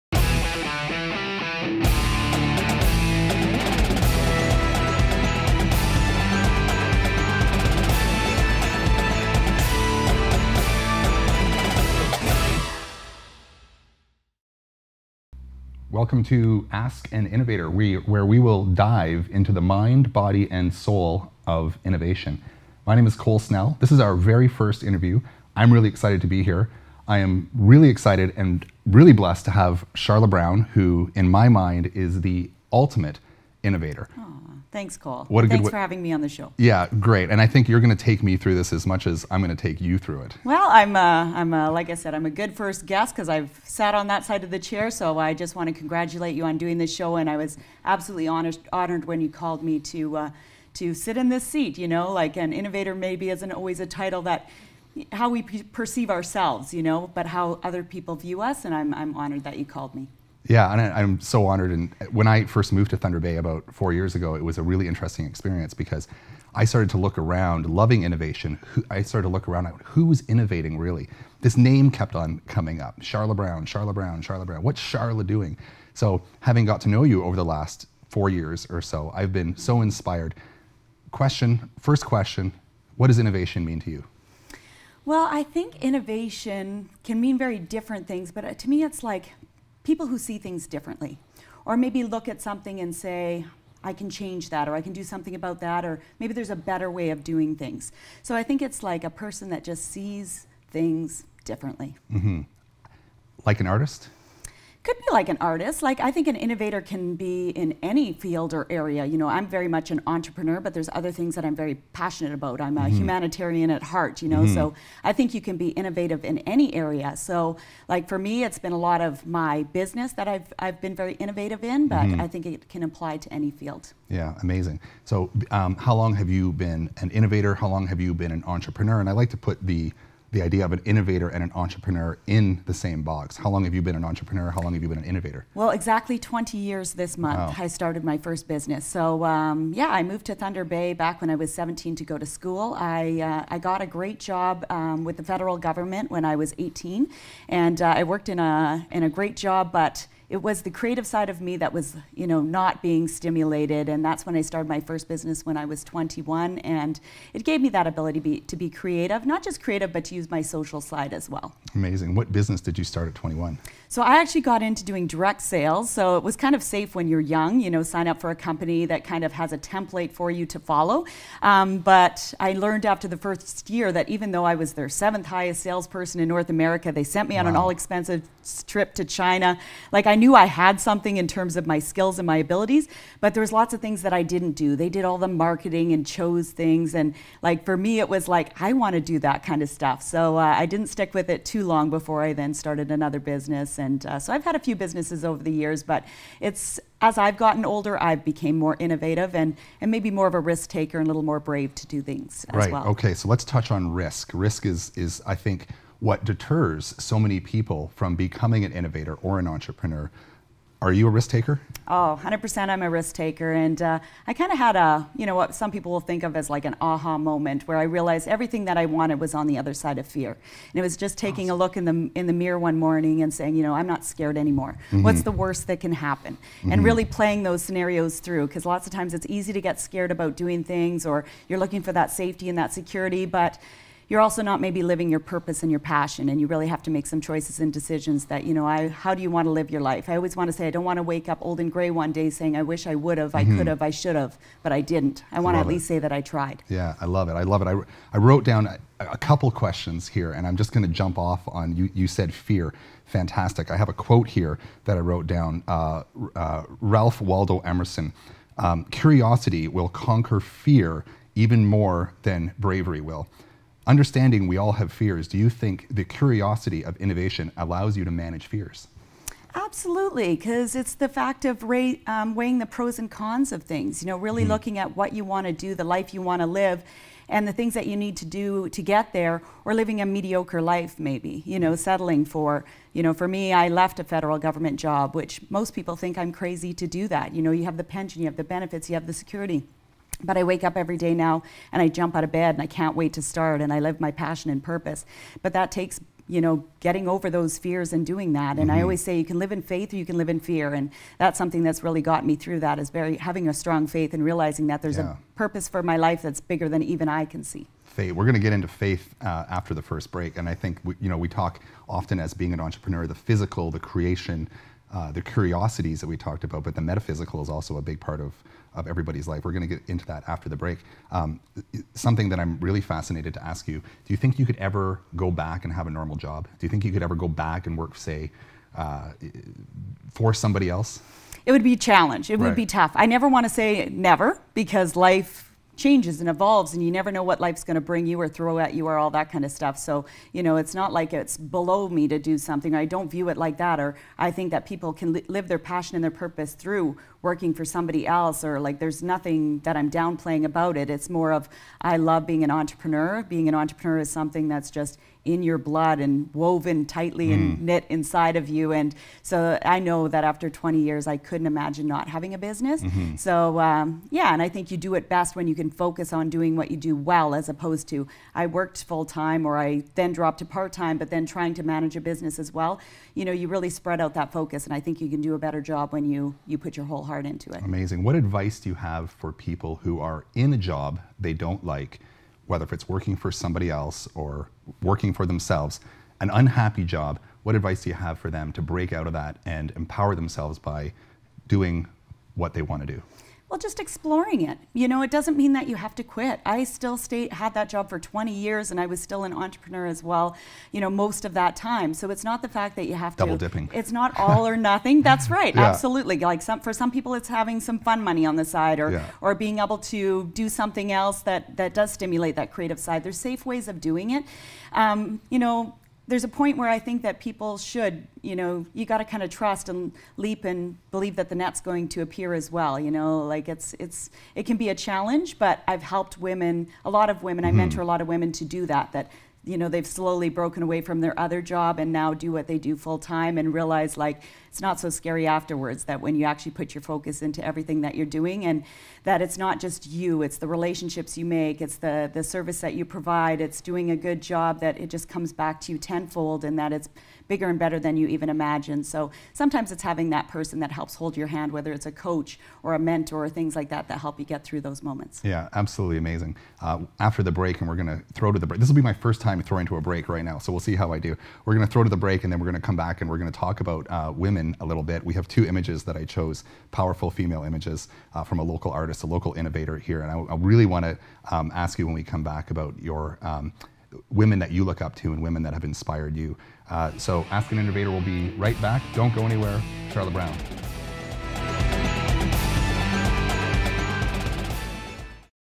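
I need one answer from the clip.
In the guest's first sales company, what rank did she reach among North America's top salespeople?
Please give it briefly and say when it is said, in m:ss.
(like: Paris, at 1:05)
seventh, at 2:54.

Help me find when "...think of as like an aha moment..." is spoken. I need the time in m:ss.
3:35.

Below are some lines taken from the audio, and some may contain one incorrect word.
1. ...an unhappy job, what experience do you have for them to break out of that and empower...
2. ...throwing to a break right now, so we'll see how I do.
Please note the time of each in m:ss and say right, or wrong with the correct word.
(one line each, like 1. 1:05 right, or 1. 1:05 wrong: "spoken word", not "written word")
1. 6:26 wrong: "advice", not "experience"
2. 7:39 right.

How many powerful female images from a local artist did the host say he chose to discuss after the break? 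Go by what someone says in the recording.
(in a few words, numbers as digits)
2.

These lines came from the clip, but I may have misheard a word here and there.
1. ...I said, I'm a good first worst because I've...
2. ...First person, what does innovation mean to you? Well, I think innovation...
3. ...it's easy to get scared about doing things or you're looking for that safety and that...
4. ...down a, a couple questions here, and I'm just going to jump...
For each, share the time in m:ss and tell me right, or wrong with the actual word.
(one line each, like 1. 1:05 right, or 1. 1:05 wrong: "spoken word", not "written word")
1. 0:41 wrong: "guest", not "worst"
2. 1:21 wrong: "question", not "person"
3. 3:49 right
4. 4:08 right.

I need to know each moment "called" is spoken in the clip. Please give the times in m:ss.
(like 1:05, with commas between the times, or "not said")
0:49, 0:59.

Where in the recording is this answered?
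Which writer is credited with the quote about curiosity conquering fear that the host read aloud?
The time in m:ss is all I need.
4:16.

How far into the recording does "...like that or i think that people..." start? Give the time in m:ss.
5:43.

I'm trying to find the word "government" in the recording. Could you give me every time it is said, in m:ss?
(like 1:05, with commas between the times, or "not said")
2:25, 4:44.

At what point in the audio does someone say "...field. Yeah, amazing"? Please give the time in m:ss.
2:03.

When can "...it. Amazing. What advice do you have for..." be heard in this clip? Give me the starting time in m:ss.
6:17.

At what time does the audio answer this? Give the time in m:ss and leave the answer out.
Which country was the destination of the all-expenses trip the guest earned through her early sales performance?
2:59.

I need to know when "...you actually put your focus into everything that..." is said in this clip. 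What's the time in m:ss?
7:16.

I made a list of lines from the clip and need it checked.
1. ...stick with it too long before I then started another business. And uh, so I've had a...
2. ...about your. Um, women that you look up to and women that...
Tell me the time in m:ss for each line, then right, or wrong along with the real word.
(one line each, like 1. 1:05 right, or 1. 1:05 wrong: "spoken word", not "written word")
1. 3:10 right
2. 7:52 right.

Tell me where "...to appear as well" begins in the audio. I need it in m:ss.
7:01.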